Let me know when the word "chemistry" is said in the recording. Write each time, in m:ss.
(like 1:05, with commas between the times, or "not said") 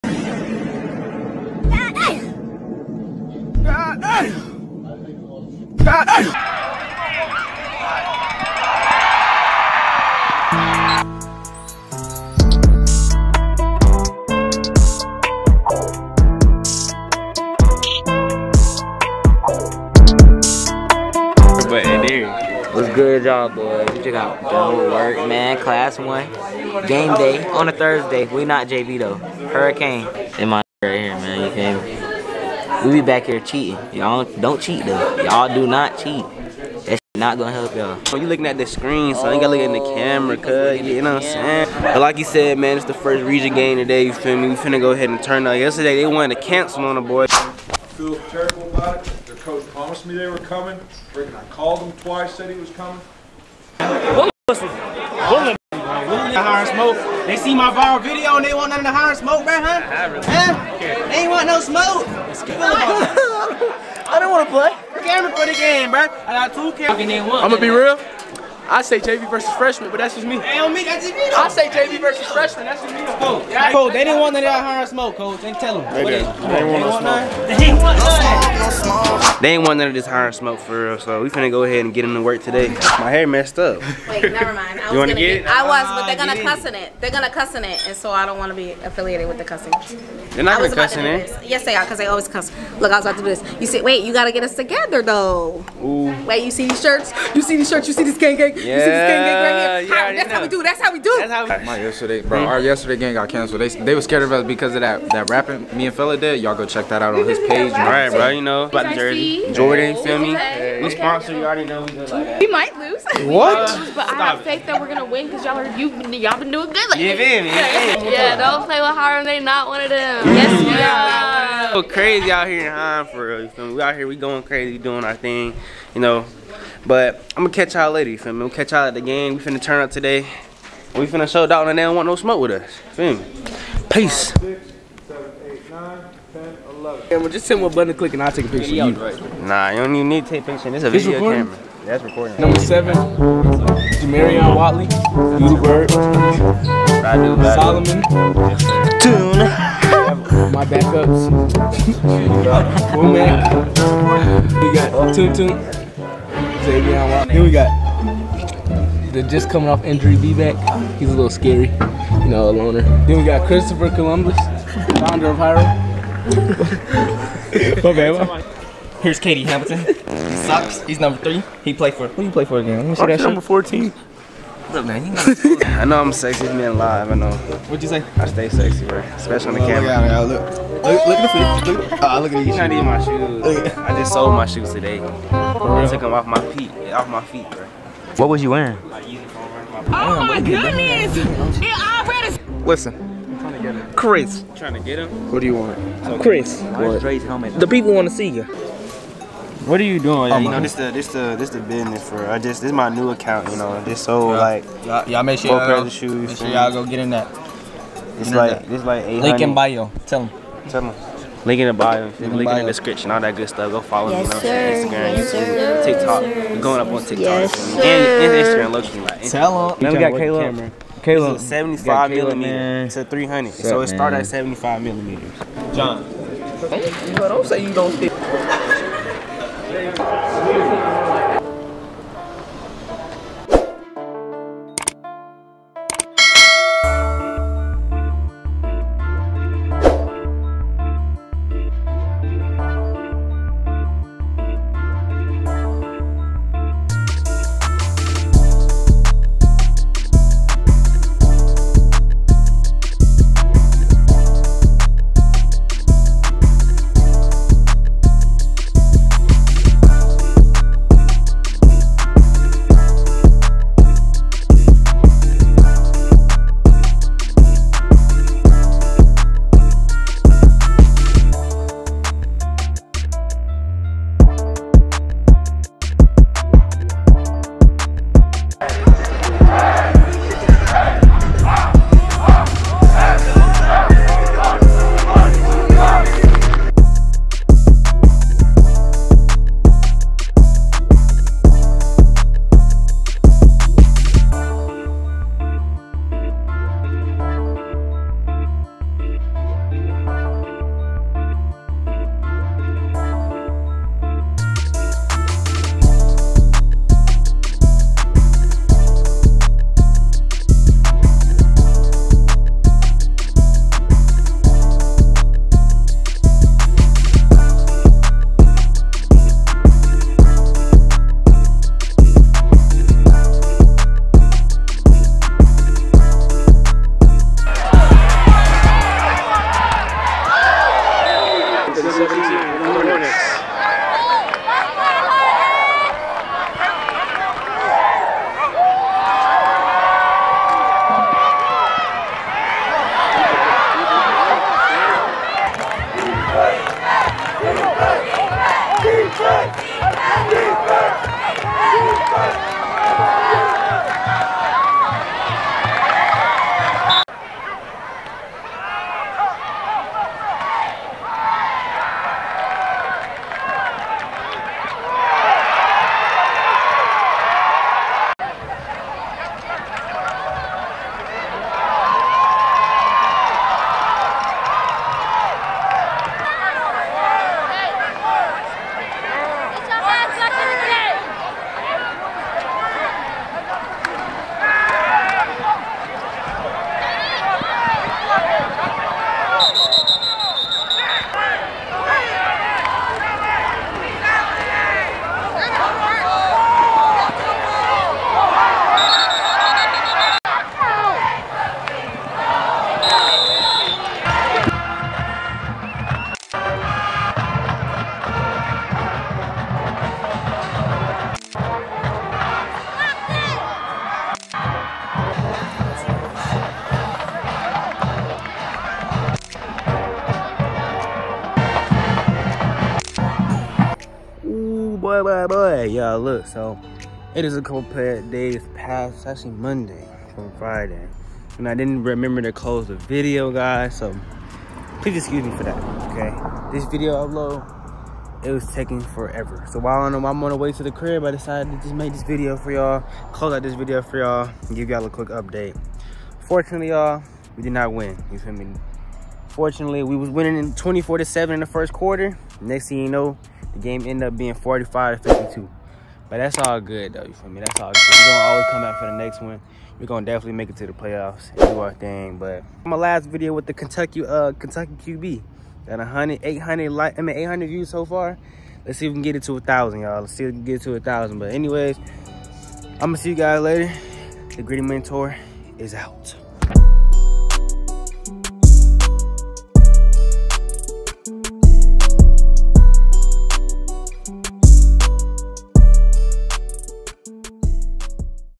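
not said.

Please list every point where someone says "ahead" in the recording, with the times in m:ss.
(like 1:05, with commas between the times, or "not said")
0:44, 1:21.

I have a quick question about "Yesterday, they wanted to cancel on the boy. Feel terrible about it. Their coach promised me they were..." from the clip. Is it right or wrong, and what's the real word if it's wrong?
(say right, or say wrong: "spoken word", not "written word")
right.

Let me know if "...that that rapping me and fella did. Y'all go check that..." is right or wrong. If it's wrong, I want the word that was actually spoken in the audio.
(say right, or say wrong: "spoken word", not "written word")
right.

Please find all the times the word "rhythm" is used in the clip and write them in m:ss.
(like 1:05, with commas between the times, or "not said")
not said.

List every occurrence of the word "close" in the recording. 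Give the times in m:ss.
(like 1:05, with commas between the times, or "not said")
7:12, 7:23.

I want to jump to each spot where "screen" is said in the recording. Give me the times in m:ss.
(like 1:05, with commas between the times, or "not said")
0:38.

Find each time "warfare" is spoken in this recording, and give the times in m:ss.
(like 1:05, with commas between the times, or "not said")
not said.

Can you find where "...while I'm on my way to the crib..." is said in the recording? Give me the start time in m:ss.
7:19.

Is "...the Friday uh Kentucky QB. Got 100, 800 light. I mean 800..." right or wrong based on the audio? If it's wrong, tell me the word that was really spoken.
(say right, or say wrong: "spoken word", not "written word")
wrong: "Kentucky", not "Friday".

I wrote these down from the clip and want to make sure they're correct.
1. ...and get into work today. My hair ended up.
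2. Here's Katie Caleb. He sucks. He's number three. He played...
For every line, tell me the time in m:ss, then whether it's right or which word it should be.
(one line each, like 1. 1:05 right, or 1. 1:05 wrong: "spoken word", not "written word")
1. 1:21 wrong: "messed", not "ended"
2. 2:49 wrong: "Hamilton", not "Caleb".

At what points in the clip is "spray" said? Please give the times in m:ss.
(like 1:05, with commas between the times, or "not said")
not said.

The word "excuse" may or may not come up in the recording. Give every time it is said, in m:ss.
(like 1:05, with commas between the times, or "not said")
7:14.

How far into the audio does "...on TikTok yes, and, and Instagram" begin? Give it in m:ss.
3:36.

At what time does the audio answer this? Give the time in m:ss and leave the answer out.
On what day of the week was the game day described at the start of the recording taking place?
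0:27.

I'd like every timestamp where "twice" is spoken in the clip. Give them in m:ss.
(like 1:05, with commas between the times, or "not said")
0:51.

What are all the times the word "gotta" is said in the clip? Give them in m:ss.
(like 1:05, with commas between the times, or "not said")
0:39, 1:34.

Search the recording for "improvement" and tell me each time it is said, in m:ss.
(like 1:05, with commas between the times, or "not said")
not said.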